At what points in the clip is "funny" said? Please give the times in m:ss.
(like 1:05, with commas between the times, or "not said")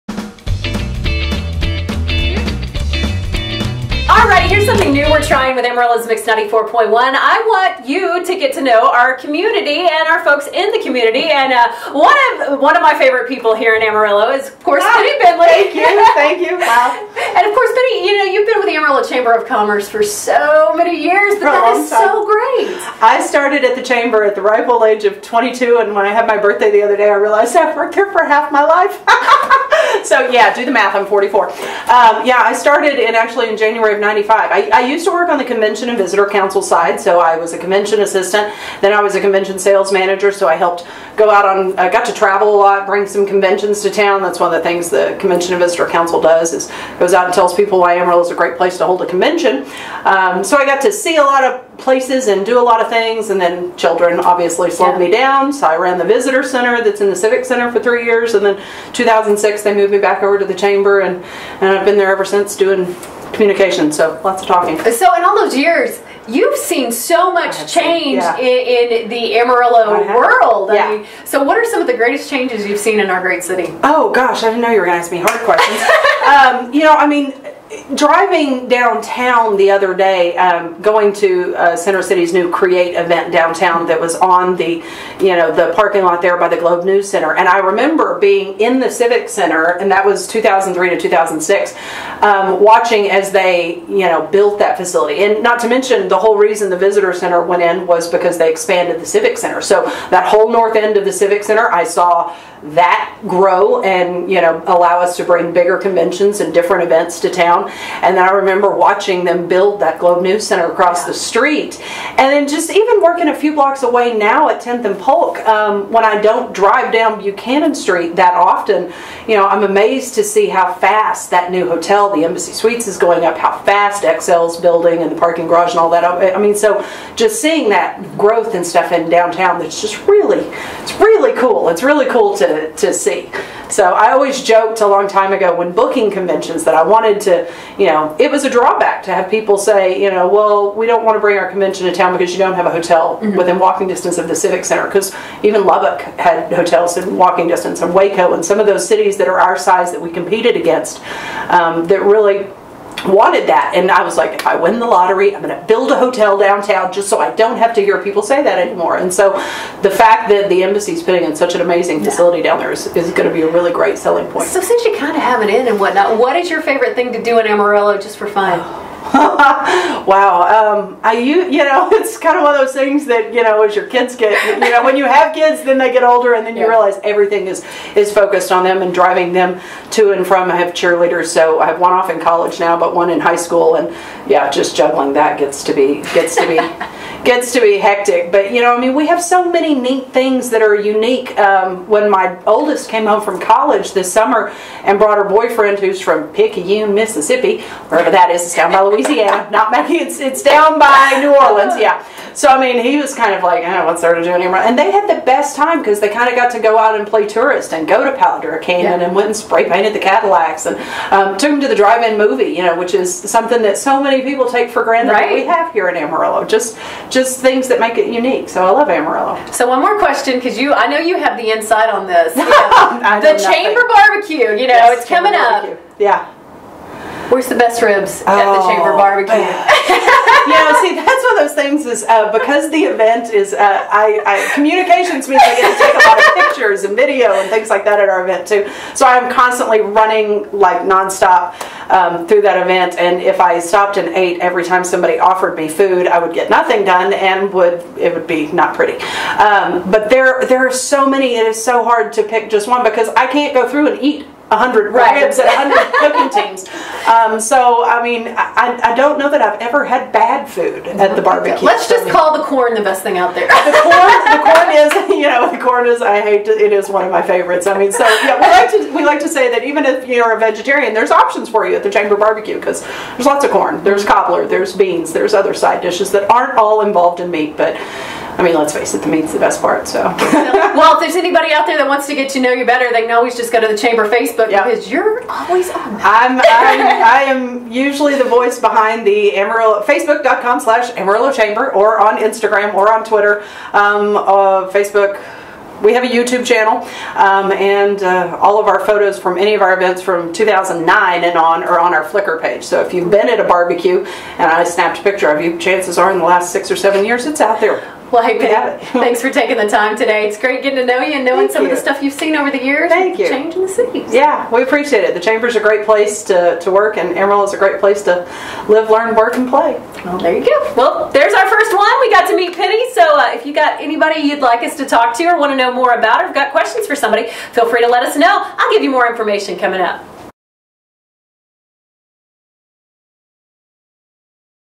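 not said.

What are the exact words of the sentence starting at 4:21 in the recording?
Let's just call the corn the best thing out there.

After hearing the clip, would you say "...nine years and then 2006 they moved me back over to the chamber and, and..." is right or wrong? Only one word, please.
wrong.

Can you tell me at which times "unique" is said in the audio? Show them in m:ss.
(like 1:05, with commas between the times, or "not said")
3:10, 3:38.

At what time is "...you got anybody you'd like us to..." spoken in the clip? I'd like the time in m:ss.
5:23.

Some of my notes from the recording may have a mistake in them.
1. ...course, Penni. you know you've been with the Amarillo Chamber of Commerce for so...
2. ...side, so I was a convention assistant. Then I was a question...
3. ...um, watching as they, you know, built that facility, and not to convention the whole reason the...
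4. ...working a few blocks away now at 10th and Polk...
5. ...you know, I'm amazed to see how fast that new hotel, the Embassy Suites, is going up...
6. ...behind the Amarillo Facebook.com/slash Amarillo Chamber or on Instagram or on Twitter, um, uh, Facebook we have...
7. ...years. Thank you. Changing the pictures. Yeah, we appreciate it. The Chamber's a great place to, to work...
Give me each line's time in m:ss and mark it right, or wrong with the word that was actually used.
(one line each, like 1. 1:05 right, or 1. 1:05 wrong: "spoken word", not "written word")
1. 0:17 right
2. 0:36 wrong: "convention", not "question"
3. 1:32 wrong: "mention", not "convention"
4. 1:53 right
5. 1:59 right
6. 4:48 right
7. 5:12 wrong: "cities", not "pictures".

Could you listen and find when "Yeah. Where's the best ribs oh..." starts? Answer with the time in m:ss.
3:45.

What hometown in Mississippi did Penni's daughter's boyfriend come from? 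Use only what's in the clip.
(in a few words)
Picayune.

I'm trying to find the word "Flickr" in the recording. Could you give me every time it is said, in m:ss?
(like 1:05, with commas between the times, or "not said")
5:02.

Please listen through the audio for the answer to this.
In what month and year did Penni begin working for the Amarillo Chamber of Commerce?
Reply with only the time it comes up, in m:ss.
0:33.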